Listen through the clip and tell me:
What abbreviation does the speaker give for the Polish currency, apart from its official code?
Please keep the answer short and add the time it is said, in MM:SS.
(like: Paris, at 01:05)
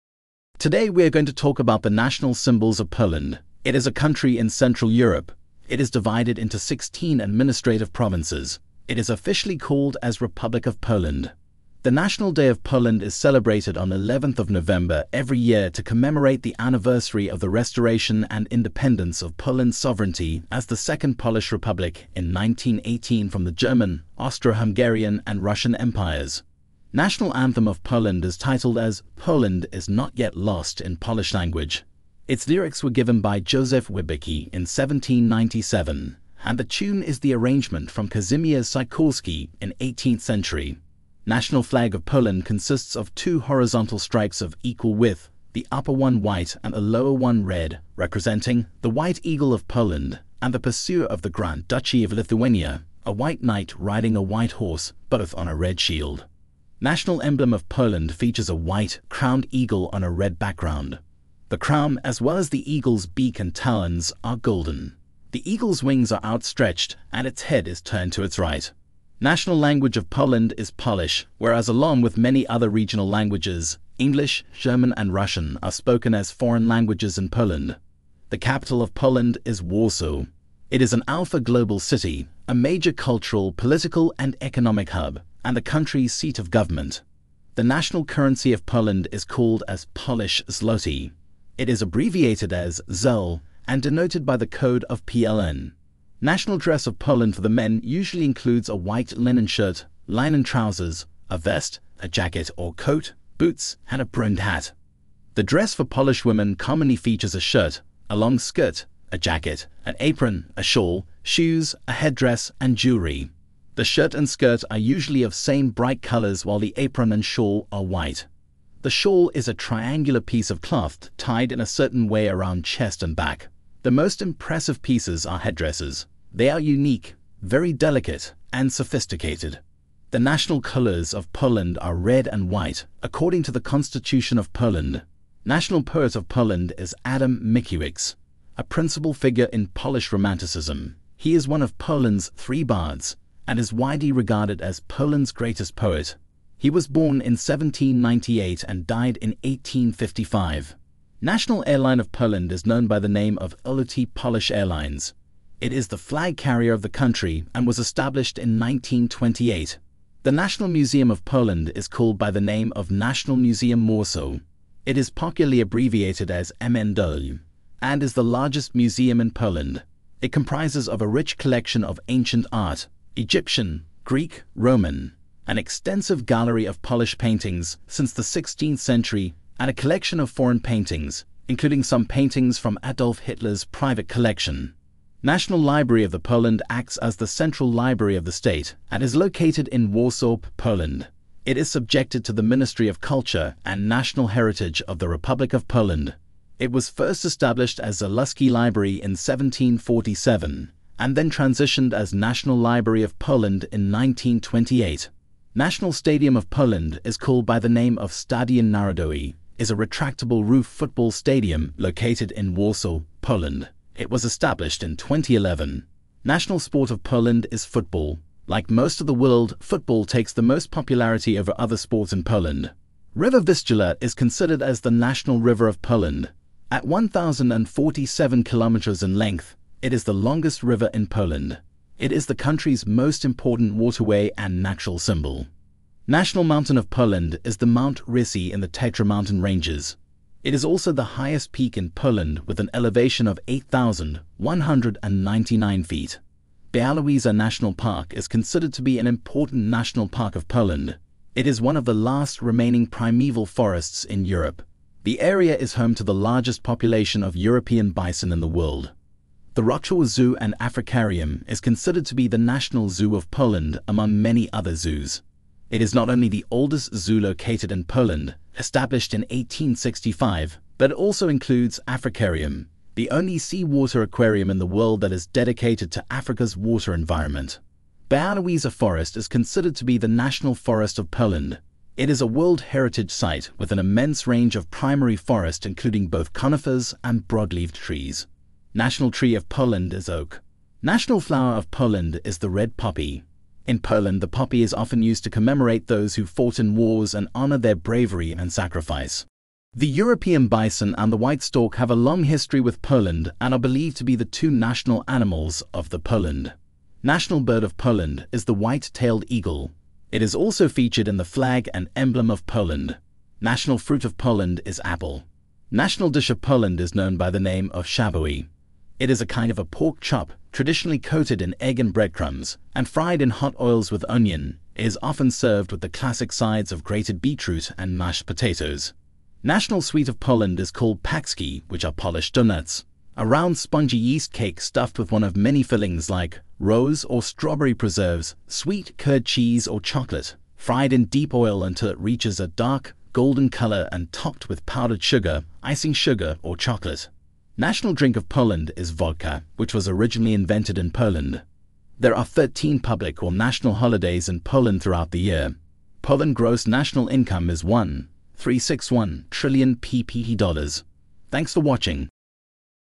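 ZEL, at 01:32.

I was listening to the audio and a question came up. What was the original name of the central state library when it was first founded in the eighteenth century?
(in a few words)
Zaluski Library.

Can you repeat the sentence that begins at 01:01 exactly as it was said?
The crown, as well as the eagle's beak and talons, are golden.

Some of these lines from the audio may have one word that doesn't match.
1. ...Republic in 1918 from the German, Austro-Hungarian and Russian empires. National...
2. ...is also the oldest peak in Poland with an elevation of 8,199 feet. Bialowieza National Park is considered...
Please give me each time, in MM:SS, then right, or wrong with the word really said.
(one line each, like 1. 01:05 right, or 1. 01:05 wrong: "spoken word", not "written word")
1. 00:21 right
2. 04:00 wrong: "highest", not "oldest".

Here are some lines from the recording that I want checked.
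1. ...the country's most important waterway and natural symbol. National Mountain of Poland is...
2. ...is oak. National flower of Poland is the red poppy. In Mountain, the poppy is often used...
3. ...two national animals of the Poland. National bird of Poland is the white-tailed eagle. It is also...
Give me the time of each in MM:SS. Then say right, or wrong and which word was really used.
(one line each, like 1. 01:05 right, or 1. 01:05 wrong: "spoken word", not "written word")
1. 03:52 right
2. 04:49 wrong: "Poland", not "Mountain"
3. 05:04 right.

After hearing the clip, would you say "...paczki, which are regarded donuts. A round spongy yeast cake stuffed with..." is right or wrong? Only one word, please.
wrong.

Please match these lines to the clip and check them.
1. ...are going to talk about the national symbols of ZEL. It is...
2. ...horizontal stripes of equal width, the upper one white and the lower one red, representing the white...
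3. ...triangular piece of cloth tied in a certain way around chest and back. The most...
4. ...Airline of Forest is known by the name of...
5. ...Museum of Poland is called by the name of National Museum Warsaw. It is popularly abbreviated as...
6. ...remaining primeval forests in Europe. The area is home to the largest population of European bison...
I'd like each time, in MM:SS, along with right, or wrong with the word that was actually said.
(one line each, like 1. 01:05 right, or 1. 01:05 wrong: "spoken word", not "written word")
1. 00:01 wrong: "Poland", not "ZEL"
2. 00:43 right
3. 01:59 right
4. 02:31 wrong: "Poland", not "Forest"
5. 02:40 right
6. 04:12 right.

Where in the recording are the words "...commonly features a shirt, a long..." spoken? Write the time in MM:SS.
01:46.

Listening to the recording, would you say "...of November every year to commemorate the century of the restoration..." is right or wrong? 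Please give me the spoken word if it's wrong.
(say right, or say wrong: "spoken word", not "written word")
wrong: "anniversary", not "century".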